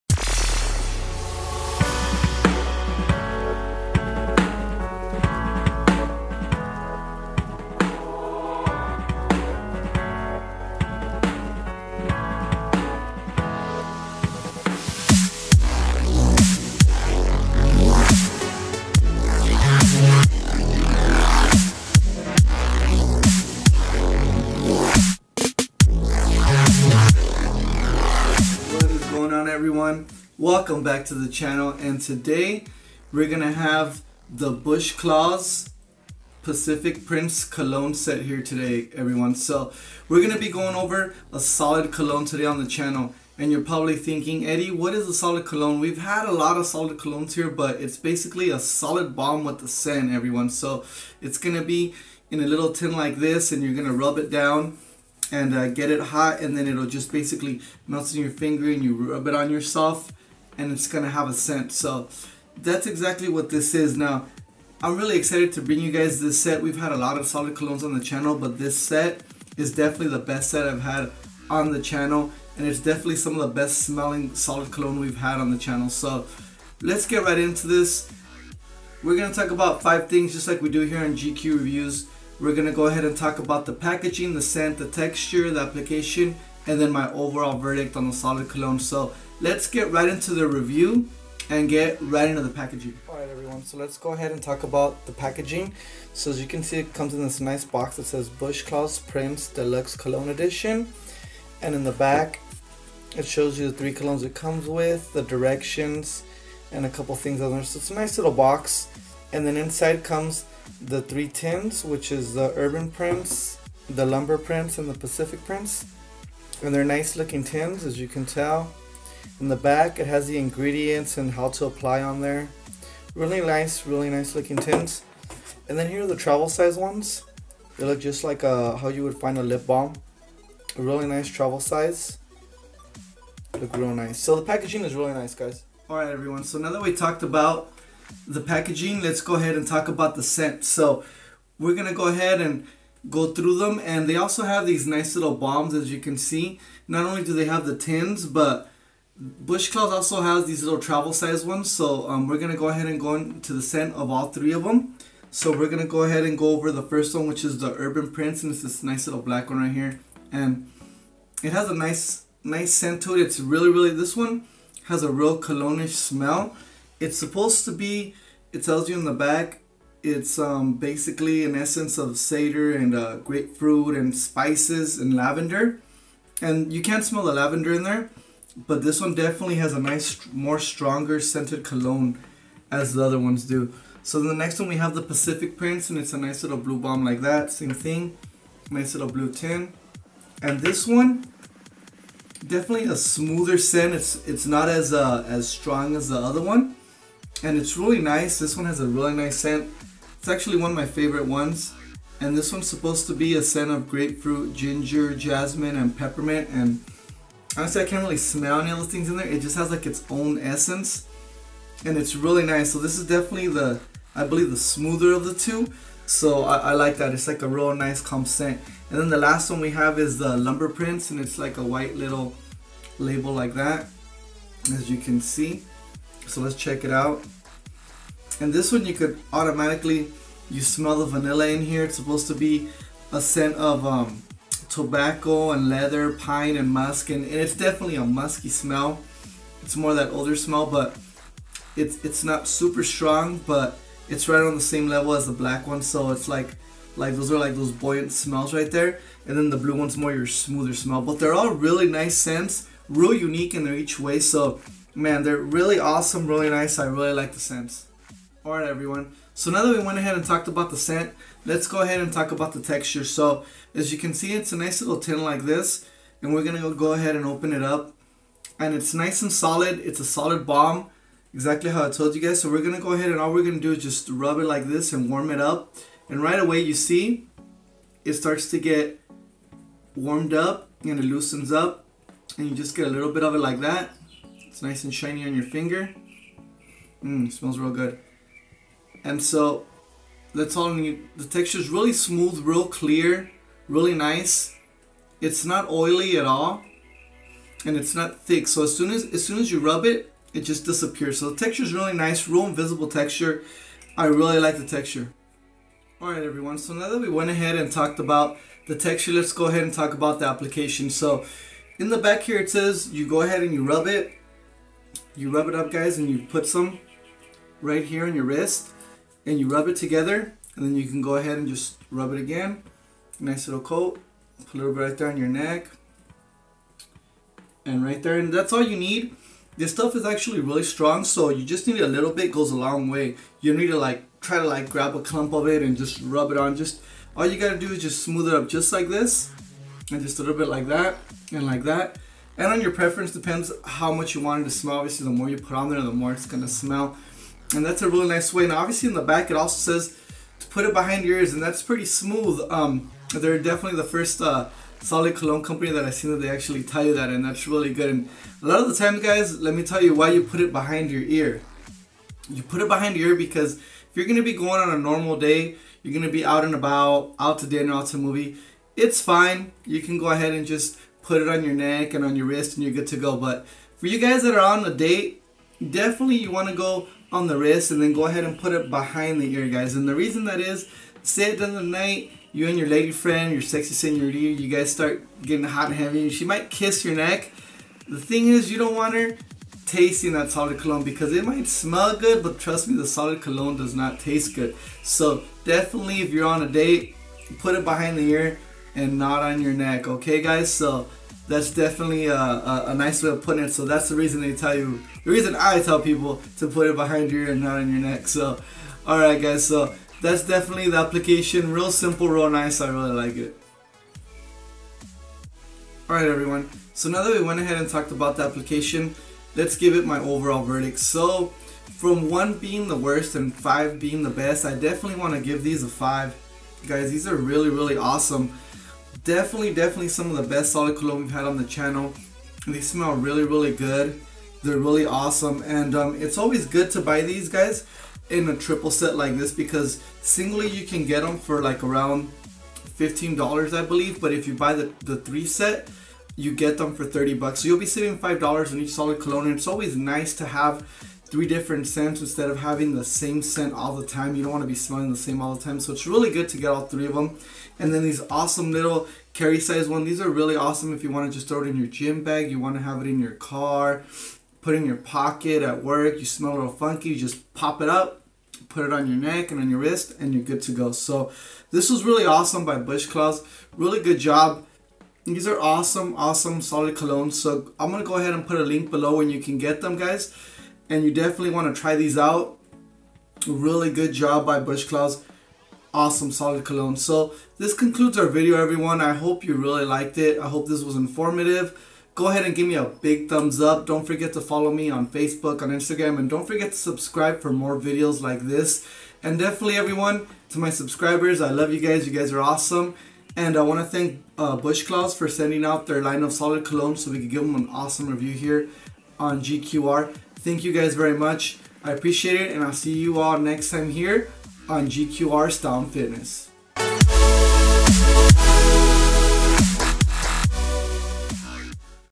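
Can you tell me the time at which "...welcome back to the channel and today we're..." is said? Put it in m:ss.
0:30.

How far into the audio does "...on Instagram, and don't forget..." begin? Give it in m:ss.
8:15.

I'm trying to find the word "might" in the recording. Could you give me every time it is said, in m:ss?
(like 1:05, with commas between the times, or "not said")
6:26, 6:31.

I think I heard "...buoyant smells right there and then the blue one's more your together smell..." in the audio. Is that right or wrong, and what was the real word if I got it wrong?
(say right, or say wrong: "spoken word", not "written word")
wrong: "smoother", not "together".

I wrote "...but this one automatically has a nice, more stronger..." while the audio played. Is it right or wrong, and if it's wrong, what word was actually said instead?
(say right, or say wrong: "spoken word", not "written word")
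wrong: "definitely", not "automatically".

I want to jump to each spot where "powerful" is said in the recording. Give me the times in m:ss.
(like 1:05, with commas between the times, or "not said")
not said.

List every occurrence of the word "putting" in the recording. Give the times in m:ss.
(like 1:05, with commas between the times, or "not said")
6:43.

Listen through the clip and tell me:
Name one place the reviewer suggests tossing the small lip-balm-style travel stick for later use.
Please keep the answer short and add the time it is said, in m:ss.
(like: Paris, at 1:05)
gym bag, at 7:41.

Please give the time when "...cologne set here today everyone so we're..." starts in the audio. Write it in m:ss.
0:37.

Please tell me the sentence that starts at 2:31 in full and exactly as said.
So um, we're gonna go ahead and go into the scent of all three of them.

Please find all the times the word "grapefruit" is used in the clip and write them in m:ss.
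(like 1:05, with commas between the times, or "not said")
2:53, 3:23.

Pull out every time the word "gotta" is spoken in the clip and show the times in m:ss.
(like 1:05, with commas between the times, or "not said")
5:37.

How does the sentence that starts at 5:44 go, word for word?
Obviously, the more you put on there, the more it's gonna smell.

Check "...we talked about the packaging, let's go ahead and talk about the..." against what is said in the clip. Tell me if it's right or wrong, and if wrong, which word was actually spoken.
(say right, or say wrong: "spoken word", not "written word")
right.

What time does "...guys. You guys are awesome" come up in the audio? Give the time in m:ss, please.
8:21.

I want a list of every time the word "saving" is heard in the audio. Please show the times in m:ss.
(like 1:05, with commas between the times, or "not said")
7:27.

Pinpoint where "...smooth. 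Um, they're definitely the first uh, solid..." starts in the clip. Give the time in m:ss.
5:51.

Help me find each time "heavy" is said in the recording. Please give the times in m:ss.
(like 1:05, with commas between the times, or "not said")
6:25.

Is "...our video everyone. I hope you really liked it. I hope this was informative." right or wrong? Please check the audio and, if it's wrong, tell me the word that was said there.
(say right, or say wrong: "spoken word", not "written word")
right.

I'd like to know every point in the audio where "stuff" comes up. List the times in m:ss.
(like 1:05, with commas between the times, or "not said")
5:29.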